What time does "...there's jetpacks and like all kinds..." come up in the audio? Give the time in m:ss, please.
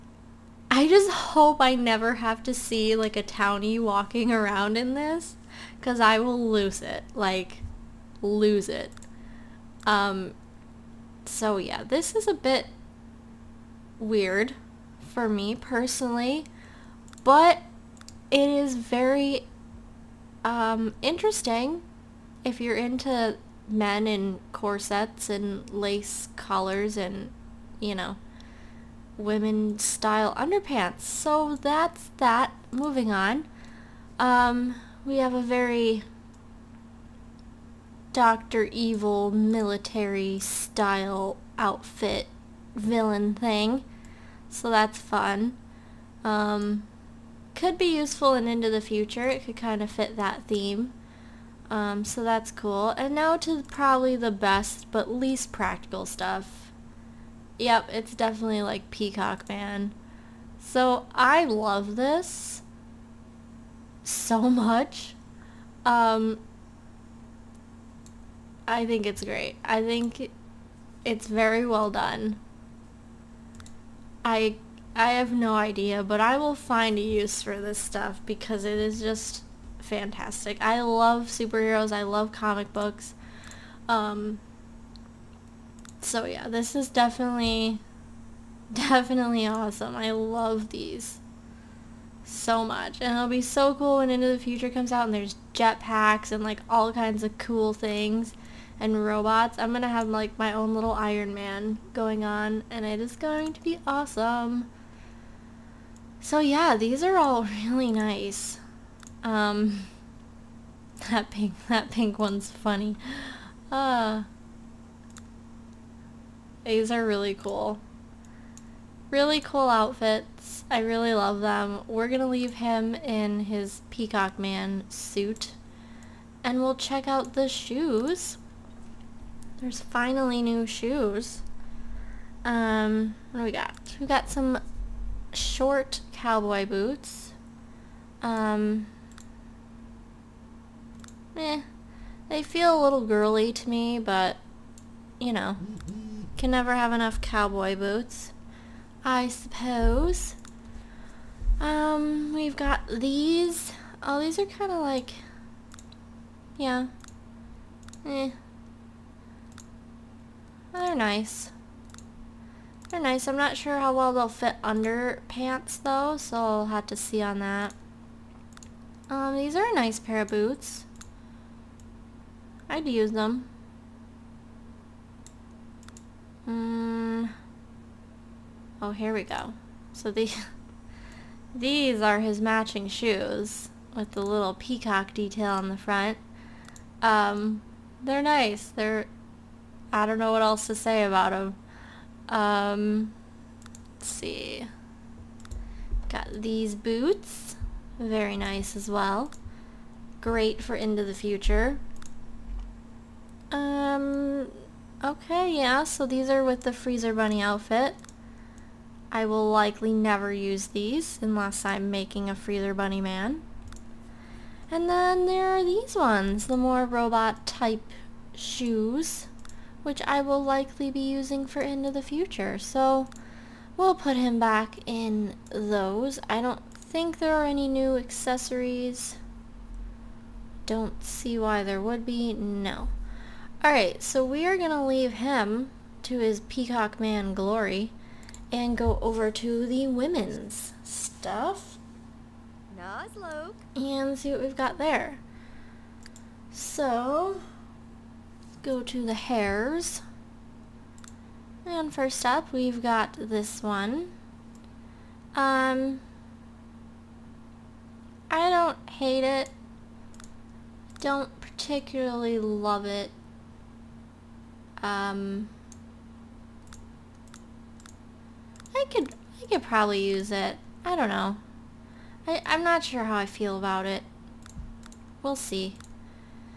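1:35.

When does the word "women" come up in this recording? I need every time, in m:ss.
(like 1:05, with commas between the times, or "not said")
0:29, 3:59.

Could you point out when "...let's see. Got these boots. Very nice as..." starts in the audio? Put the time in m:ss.
3:13.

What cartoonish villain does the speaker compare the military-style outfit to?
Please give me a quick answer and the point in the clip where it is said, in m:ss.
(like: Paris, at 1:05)
Dr. Evil, at 0:38.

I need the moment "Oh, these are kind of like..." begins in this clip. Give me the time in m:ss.
2:34.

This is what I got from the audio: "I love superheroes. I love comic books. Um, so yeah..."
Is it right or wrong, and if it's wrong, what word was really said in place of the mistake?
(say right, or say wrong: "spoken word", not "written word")
right.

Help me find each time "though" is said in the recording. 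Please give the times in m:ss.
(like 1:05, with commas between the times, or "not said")
2:45.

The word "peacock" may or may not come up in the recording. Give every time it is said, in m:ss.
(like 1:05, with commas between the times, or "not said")
0:58, 2:03, 3:04, 3:56.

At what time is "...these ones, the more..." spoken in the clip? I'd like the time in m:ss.
3:35.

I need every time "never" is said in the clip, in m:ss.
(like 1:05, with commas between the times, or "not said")
0:01, 2:26, 3:29.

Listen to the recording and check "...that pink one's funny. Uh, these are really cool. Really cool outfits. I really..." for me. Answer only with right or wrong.
right.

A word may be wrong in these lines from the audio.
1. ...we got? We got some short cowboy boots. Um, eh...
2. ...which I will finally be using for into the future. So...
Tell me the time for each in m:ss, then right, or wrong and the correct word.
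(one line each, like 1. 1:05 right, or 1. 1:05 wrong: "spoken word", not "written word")
1. 2:13 right
2. 3:39 wrong: "likely", not "finally".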